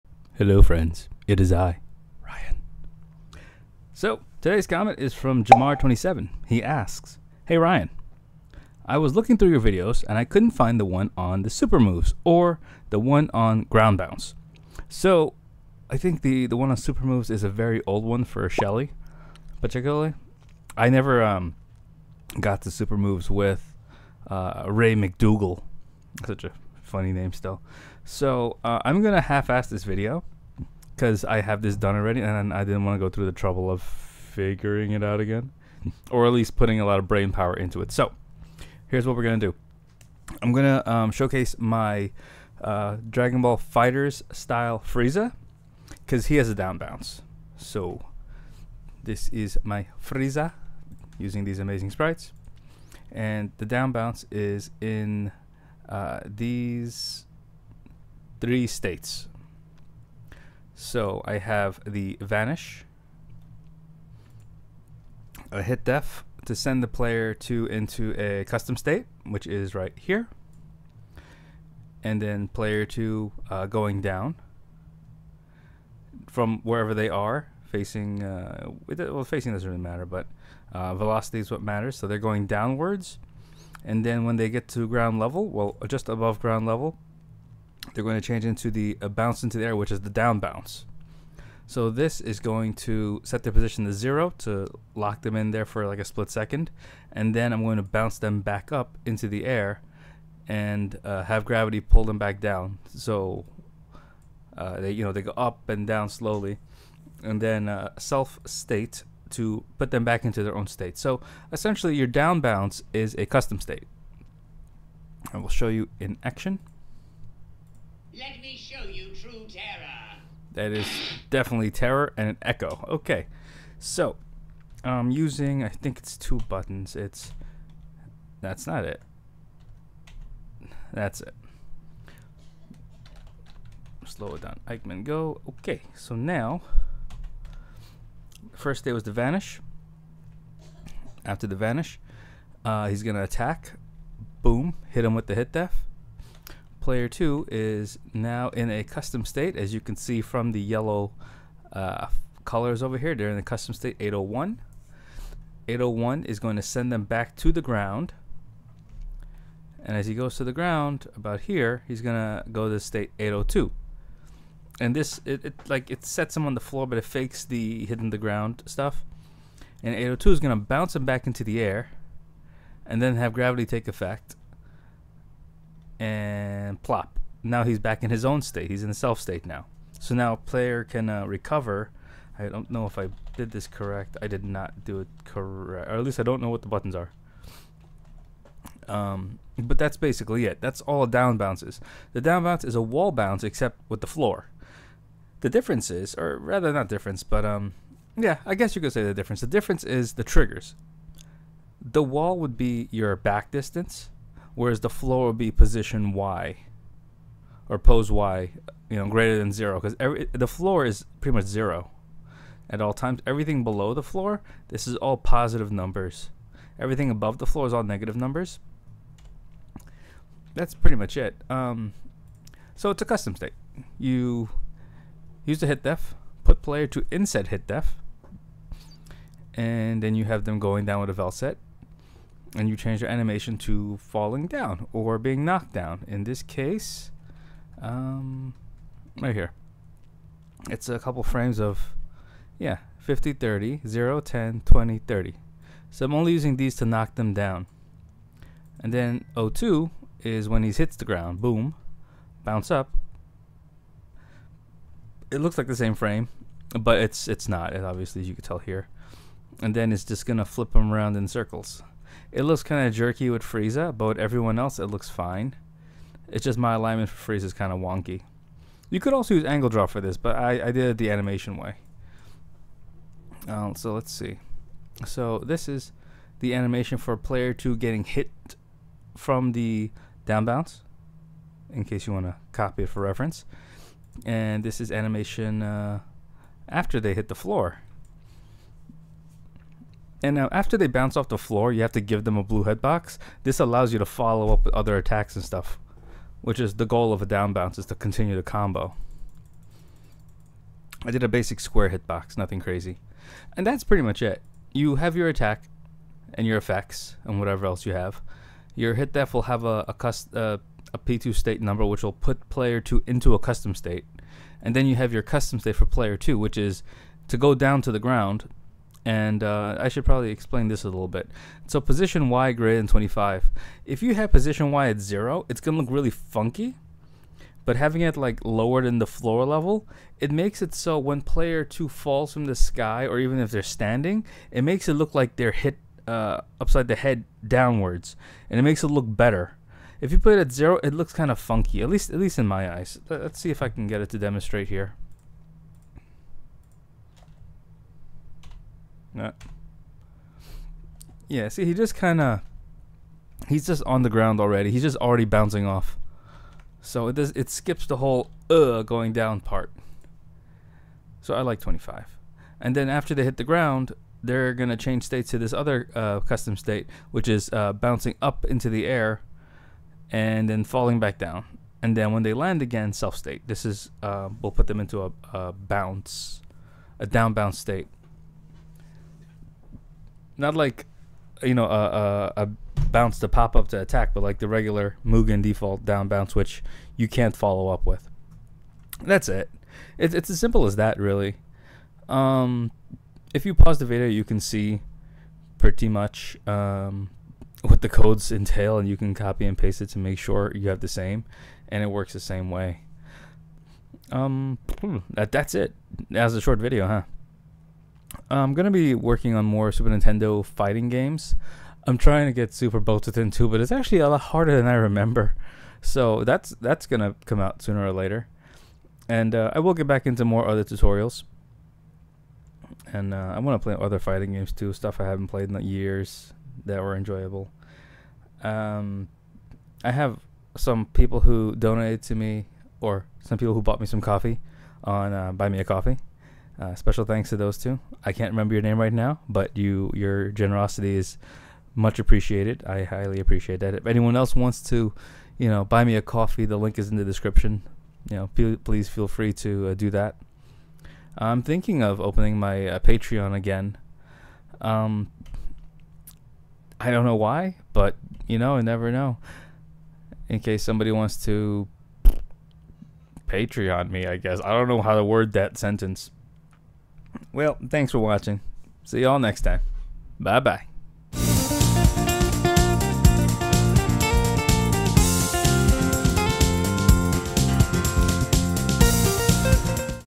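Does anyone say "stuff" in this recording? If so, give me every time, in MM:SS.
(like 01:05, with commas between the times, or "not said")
02:48, 04:55, 07:04.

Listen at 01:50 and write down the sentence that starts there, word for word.
So essentially your down bounce is a custom state.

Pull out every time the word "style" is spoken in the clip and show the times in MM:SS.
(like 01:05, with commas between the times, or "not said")
00:44.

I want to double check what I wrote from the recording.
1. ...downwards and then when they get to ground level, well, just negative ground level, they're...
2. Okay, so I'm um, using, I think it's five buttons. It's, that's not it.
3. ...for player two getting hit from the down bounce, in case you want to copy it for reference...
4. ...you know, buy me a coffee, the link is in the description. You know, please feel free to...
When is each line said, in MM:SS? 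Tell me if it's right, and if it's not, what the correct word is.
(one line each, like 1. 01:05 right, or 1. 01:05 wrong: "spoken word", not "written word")
1. 01:22 wrong: "above", not "negative"
2. 02:02 wrong: "two", not "five"
3. 04:36 right
4. 07:25 right.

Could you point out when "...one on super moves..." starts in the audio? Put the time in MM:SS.
00:16.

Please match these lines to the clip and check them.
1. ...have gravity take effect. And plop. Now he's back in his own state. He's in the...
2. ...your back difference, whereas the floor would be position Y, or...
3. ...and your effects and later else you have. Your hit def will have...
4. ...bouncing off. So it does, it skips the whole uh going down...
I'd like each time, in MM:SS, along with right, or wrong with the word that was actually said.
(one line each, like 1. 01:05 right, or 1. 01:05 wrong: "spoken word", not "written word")
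1. 02:53 right
2. 03:22 wrong: "distance", not "difference"
3. 05:06 wrong: "whatever", not "later"
4. 05:55 right.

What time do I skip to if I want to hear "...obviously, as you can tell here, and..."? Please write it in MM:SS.
04:17.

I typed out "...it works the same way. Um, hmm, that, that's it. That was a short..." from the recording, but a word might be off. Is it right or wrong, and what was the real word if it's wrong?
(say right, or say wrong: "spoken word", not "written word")
right.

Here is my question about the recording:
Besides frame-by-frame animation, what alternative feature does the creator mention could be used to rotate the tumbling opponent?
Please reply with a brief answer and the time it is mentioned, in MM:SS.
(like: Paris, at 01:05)
angle draw, at 04:29.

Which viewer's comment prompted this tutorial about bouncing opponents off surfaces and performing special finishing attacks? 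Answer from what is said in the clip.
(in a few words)
Jamar27.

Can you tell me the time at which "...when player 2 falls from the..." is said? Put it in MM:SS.
05:30.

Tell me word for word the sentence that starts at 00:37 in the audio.
So here's what we're gonna do.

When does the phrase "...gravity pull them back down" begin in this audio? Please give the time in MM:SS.
01:41.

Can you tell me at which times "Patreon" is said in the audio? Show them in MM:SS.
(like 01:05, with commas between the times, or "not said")
07:32, 07:43.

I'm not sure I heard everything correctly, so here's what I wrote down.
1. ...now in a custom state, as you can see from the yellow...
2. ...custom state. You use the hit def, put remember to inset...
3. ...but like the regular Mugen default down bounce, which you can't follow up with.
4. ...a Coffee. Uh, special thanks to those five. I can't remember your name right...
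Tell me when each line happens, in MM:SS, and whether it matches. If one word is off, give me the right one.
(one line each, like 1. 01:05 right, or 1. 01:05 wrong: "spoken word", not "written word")
1. 02:28 right
2. 03:43 wrong: "player", not "remember"
3. 06:24 right
4. 07:15 wrong: "two", not "five".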